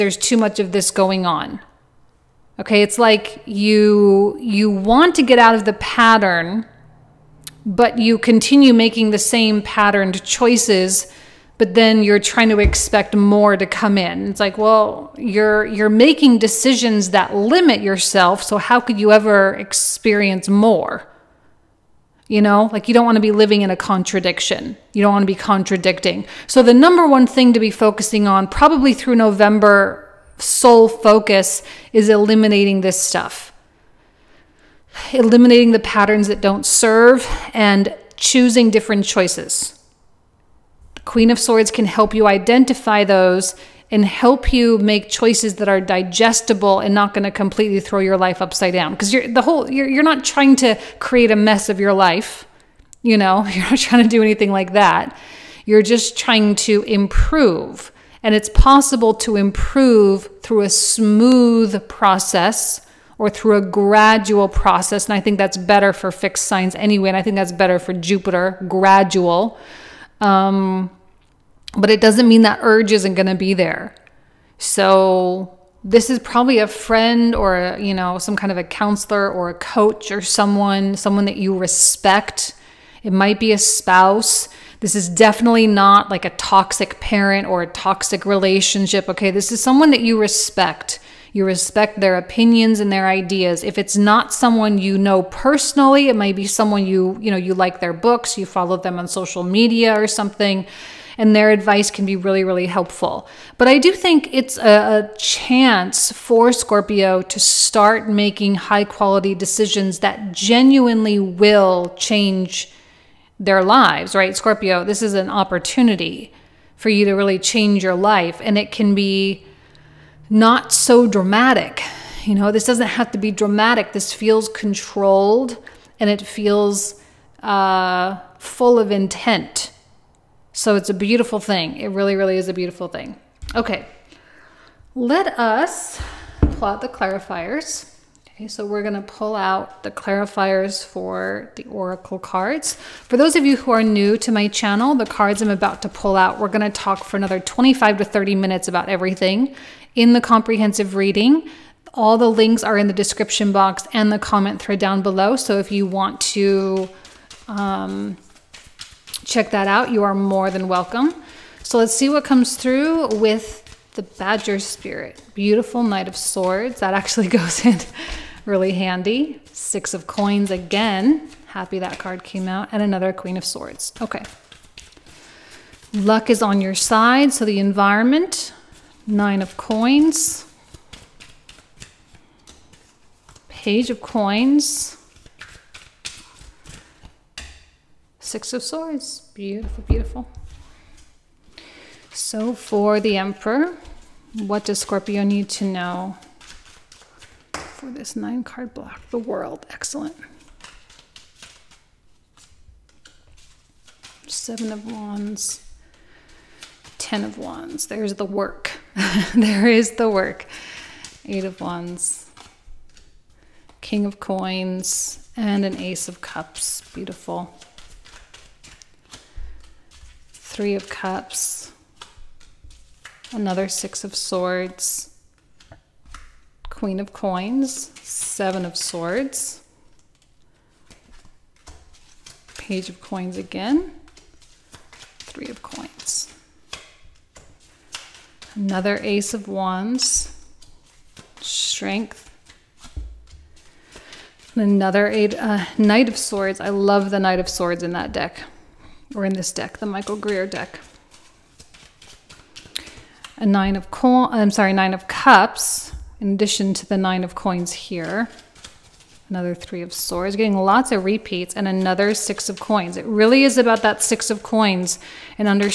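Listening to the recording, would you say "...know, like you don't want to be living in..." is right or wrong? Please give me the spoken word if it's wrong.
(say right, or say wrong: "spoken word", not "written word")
right.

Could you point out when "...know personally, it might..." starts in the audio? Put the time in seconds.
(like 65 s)
94 s.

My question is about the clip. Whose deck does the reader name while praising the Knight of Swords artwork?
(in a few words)
Michael Greer.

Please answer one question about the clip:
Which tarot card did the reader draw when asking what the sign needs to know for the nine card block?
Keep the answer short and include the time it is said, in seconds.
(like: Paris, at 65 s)
The World, at 199 s.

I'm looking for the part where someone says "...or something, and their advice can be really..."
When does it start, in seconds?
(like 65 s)
99 s.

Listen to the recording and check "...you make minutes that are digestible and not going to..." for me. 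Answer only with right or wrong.
wrong.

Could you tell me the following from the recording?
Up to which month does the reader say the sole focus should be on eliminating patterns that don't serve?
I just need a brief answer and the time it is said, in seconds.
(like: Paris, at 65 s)
November, at 29 s.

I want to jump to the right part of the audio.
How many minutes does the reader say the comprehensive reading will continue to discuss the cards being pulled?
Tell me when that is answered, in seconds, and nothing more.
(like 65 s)
147 s.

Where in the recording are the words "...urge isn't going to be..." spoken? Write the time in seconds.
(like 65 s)
72 s.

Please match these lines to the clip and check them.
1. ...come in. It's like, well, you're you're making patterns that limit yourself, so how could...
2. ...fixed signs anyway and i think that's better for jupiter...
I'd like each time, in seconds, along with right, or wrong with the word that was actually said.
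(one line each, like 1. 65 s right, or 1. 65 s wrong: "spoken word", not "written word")
1. 13 s wrong: "decisions", not "patterns"
2. 66 s right.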